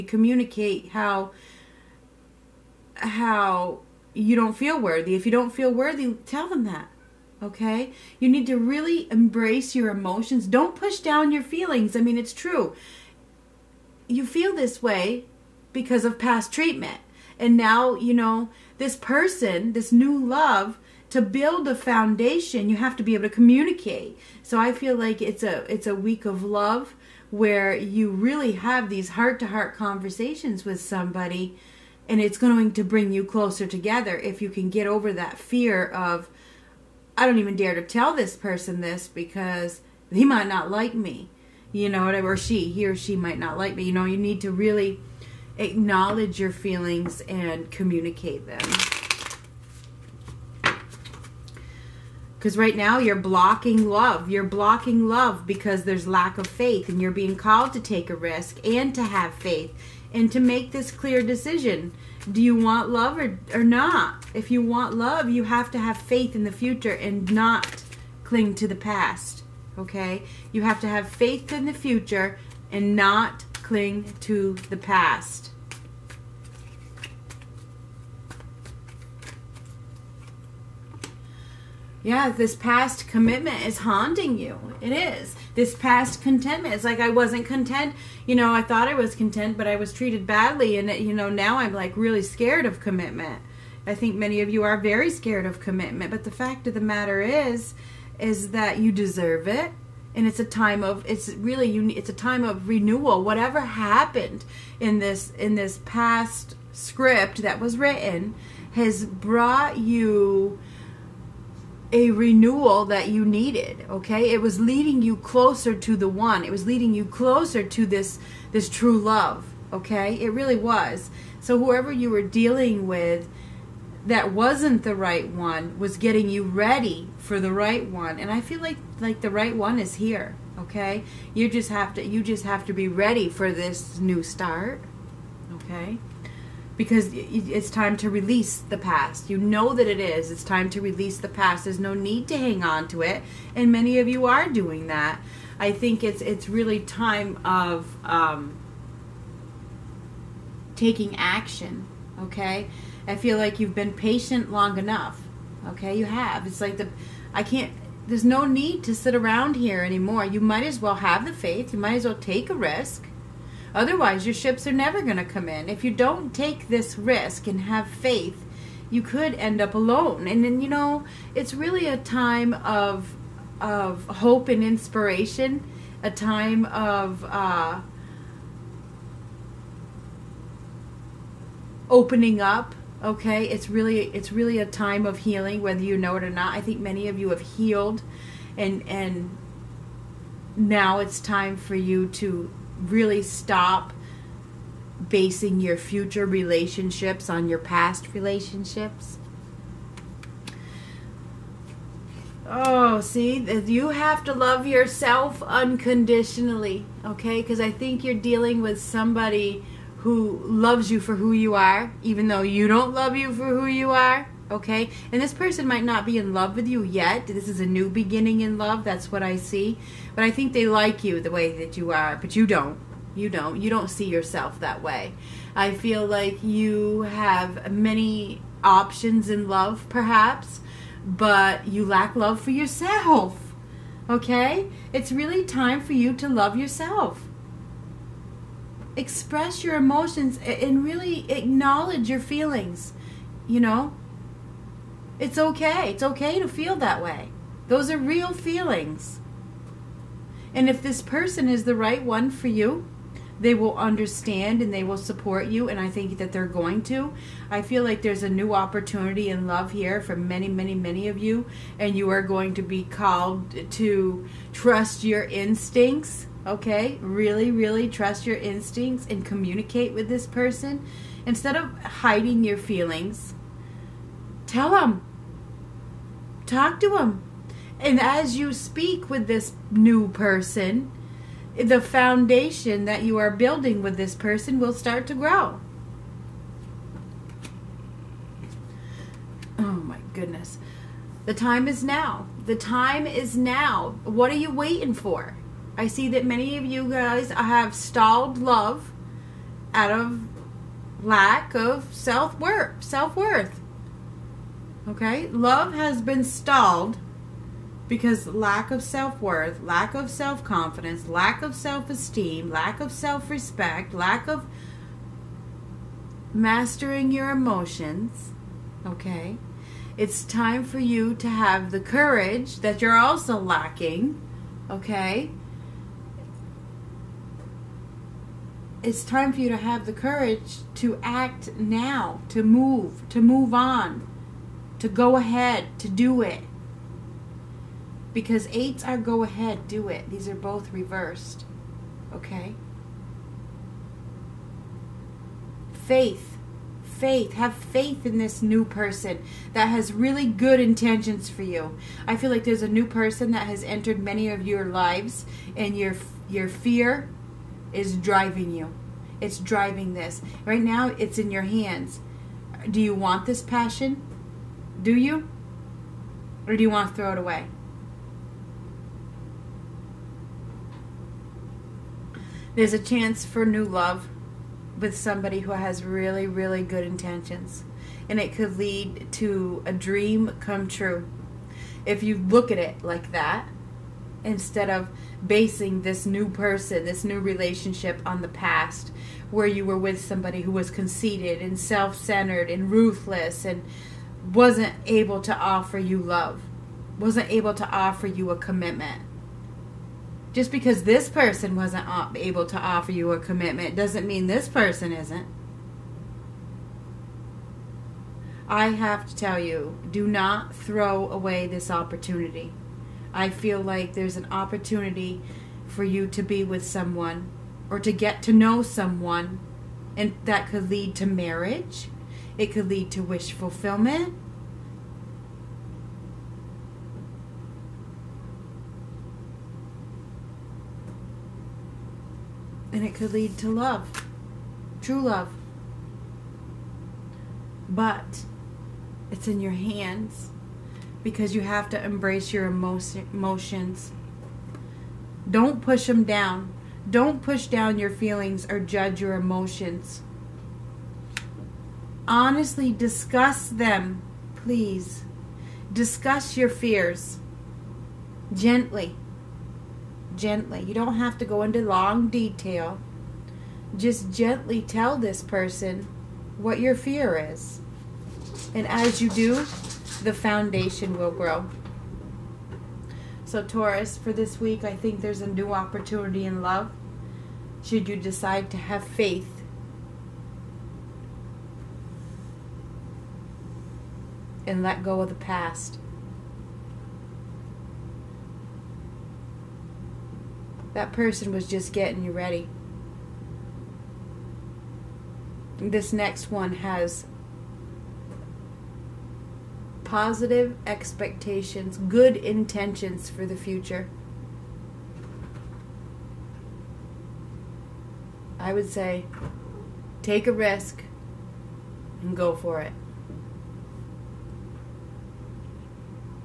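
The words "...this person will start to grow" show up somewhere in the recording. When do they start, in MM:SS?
04:43.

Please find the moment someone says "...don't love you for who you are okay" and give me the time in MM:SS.
03:32.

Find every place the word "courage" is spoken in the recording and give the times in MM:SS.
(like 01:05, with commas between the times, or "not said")
05:21, 05:29.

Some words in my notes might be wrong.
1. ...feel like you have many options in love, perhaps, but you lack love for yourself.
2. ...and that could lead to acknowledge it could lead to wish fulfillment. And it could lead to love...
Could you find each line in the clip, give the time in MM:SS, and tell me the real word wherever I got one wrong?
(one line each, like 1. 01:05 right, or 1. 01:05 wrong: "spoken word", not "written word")
1. 03:45 right
2. 06:59 wrong: "marriage", not "acknowledge".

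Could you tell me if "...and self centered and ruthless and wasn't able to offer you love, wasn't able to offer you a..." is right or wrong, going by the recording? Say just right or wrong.
right.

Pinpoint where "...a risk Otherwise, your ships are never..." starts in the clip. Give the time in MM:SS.
02:42.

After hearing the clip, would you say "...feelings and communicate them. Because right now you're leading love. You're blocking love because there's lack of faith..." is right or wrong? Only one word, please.
wrong.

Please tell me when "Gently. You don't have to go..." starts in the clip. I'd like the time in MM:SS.
07:40.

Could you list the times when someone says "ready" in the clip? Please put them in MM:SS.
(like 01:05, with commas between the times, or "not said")
02:06, 02:12, 08:12.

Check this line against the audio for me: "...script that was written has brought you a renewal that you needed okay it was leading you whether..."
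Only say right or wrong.
wrong.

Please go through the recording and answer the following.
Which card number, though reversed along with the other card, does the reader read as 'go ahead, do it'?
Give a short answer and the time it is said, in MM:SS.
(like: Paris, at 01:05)
8, at 05:38.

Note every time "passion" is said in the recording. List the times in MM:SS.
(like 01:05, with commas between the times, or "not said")
06:03.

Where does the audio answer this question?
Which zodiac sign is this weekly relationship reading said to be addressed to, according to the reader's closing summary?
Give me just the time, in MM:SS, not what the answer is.
07:53.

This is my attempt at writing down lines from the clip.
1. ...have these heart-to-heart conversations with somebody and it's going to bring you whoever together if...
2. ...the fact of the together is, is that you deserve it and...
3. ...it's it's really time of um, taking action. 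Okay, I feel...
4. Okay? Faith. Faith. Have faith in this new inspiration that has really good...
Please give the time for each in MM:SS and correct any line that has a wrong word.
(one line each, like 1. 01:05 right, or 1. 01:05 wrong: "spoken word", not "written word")
1. 00:28 wrong: "closer", not "whoever"
2. 01:36 wrong: "matter", not "together"
3. 02:26 right
4. 05:42 wrong: "person", not "inspiration".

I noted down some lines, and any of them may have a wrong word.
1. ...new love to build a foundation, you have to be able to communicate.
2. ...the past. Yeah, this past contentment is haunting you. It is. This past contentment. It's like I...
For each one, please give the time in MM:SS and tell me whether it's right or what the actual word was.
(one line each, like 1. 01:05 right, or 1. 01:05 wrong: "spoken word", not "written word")
1. 00:19 right
2. 01:14 wrong: "commitment", not "contentment".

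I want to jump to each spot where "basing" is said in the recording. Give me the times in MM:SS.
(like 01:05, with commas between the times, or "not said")
03:15, 06:25.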